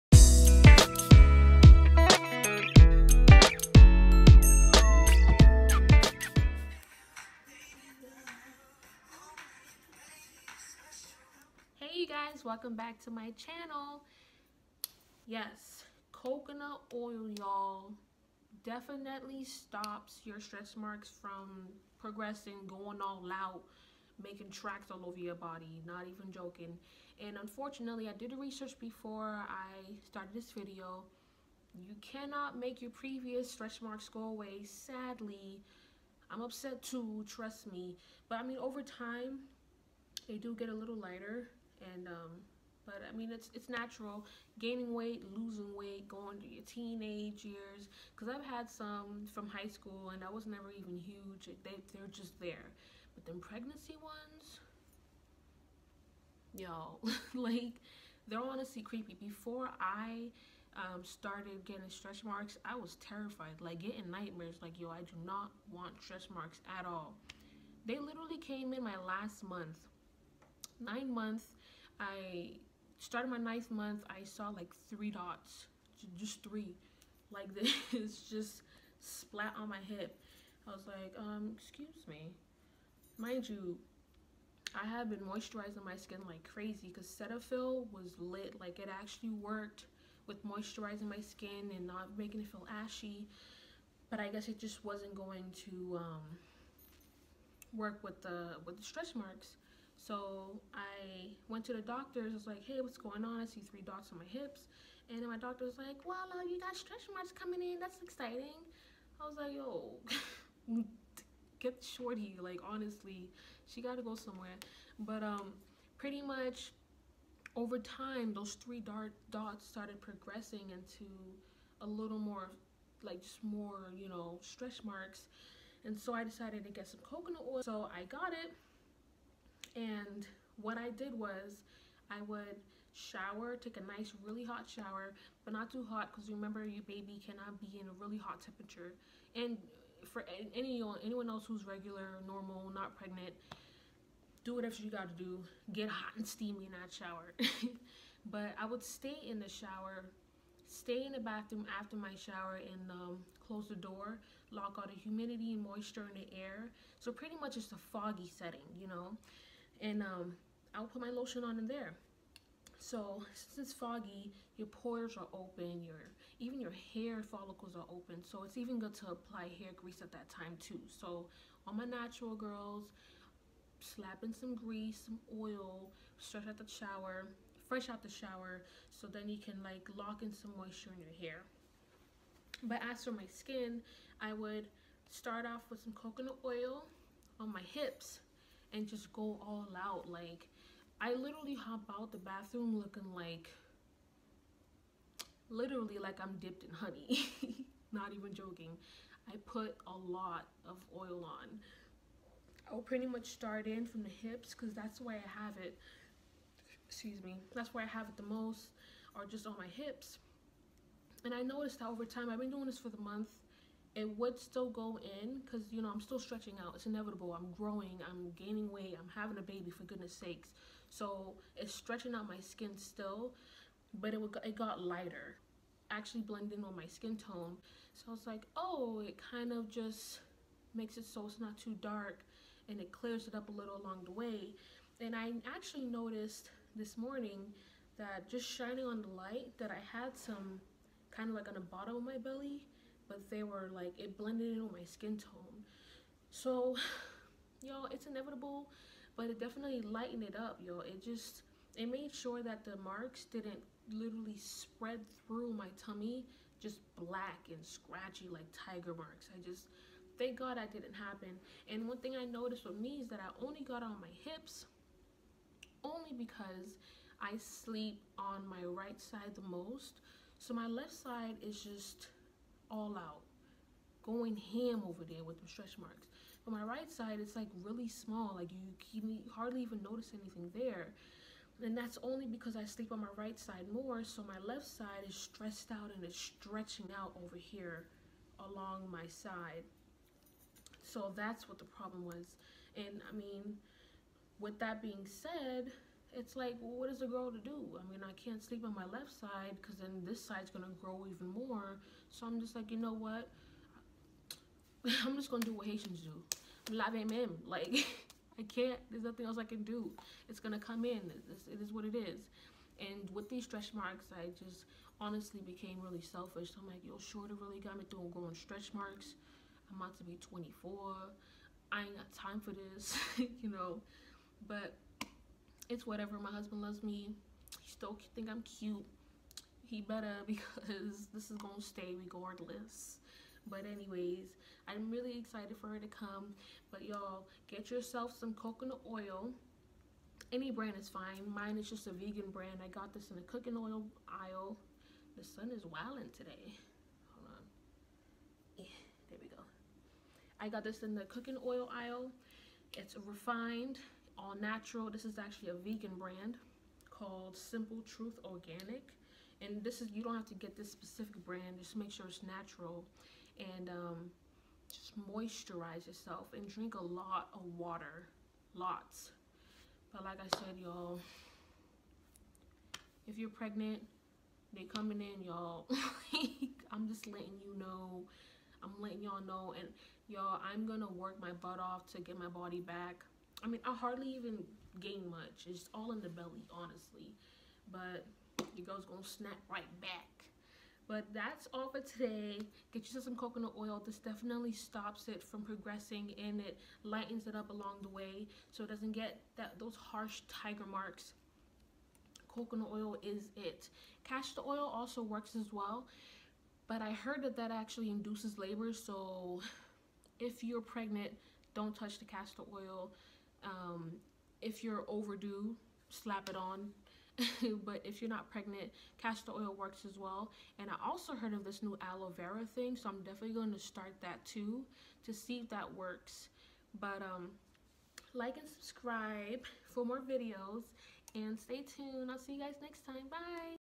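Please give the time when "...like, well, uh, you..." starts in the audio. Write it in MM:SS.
01:45.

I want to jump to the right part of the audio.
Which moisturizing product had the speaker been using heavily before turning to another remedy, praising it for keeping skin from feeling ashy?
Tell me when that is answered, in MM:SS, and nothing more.
01:27.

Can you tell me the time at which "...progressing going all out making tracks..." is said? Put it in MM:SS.
00:21.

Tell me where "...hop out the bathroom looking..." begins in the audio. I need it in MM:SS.
03:11.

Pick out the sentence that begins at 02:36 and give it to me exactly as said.
So pretty much it's a foggy setting, you know and um, I'll put my lotion on in there.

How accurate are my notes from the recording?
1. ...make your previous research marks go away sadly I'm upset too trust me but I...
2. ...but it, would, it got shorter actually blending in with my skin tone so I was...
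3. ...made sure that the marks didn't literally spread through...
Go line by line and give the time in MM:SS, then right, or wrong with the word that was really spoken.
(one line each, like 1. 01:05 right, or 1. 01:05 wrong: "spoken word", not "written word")
1. 00:32 wrong: "stretch", not "research"
2. 03:43 wrong: "lighter", not "shorter"
3. 04:11 right.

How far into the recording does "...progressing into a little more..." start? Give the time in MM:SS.
02:00.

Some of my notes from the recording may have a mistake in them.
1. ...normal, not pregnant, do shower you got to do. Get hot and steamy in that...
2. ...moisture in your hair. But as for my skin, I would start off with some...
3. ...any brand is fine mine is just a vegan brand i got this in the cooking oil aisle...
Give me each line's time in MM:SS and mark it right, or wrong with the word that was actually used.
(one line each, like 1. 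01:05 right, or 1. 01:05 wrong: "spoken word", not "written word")
1. 02:22 wrong: "whatever", not "shower"
2. 03:00 right
3. 05:40 right.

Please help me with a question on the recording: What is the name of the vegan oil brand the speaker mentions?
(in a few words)
Simple Truth Organic.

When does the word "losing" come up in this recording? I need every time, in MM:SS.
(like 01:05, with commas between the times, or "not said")
00:45.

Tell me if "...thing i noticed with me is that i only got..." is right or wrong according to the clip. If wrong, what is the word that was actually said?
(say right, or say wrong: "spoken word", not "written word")
right.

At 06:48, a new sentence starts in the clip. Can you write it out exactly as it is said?
So if you're pregnant, don't touch the castor oil.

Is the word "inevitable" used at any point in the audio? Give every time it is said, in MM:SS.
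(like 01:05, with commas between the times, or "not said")
03:36, 04:08.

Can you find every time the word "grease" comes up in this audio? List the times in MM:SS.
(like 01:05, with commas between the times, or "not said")
02:49, 02:54.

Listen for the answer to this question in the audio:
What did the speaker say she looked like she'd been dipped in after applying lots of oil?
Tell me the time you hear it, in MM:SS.
03:16.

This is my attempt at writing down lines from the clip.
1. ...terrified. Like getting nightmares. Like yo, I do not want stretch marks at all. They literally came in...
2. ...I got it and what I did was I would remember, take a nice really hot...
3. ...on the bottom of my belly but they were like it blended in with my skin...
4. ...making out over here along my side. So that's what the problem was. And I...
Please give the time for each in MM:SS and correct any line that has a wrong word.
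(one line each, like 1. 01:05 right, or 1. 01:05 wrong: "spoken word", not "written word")
1. 01:02 right
2. 02:07 wrong: "shower", not "remember"
3. 04:01 right
4. 04:46 wrong: "stretching", not "making".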